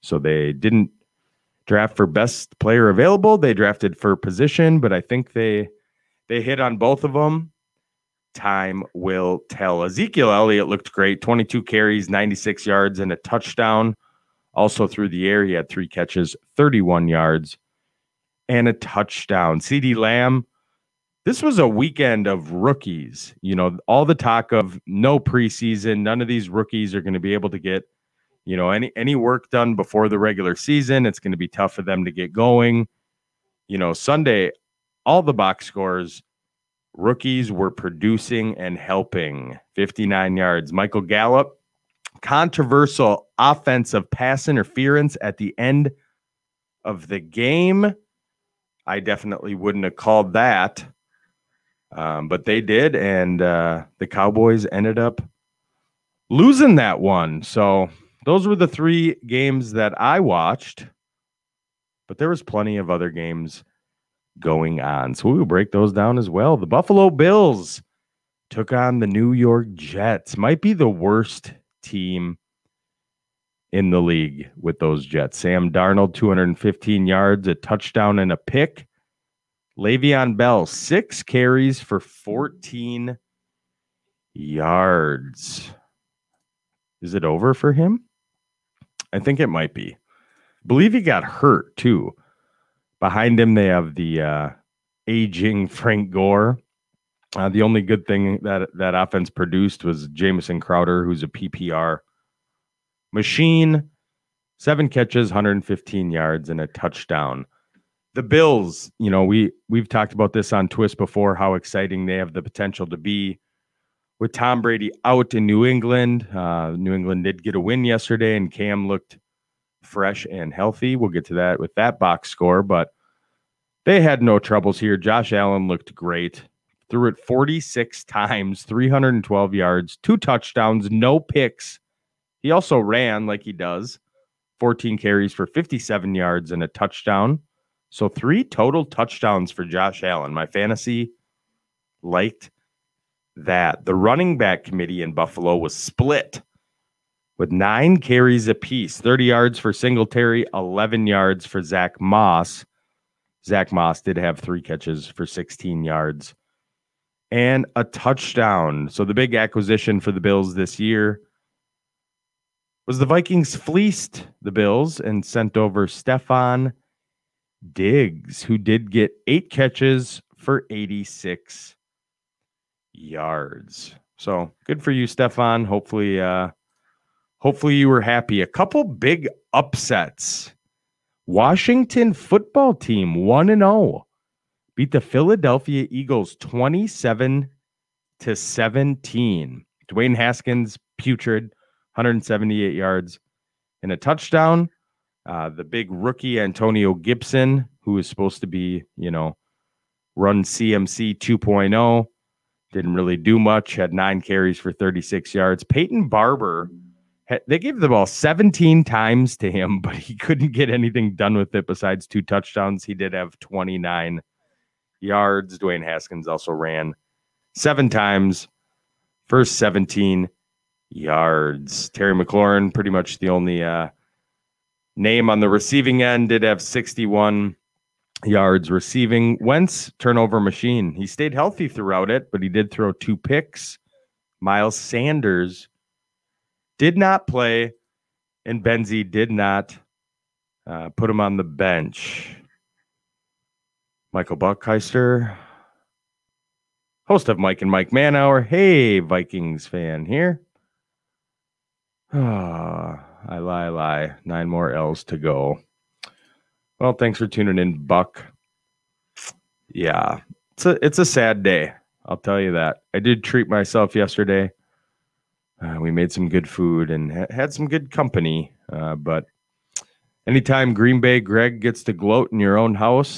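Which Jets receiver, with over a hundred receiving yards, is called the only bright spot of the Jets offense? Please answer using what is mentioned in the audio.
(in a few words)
Jamison Crowder.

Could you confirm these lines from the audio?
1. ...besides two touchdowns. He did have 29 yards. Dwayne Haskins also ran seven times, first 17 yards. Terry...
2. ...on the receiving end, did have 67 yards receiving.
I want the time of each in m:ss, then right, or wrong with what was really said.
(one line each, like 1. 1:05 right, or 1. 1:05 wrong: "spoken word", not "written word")
1. 3:31 right
2. 3:45 wrong: "61", not "67".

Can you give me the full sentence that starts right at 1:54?
With Tom Brady out in New England, uh, New England did get a win yesterday, and Cam looked fresh and healthy.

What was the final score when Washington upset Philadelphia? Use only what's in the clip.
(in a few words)
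27 to 17.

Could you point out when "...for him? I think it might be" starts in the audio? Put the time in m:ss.
1:27.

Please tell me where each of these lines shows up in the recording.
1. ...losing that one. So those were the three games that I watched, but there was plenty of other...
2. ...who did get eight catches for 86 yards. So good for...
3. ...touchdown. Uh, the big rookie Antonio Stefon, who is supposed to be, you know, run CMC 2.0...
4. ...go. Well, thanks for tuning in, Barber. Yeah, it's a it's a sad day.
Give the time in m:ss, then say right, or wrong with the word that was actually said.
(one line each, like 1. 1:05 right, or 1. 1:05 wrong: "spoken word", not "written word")
1. 0:56 right
2. 2:48 right
3. 3:13 wrong: "Gibson", not "Stefon"
4. 4:15 wrong: "Buck", not "Barber".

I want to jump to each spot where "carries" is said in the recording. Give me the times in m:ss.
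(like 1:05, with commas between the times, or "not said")
0:11, 1:21, 2:14, 2:27, 3:24.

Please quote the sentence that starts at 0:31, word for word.
It's going to be tough for them to get going.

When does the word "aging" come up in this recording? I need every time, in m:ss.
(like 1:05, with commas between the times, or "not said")
1:35.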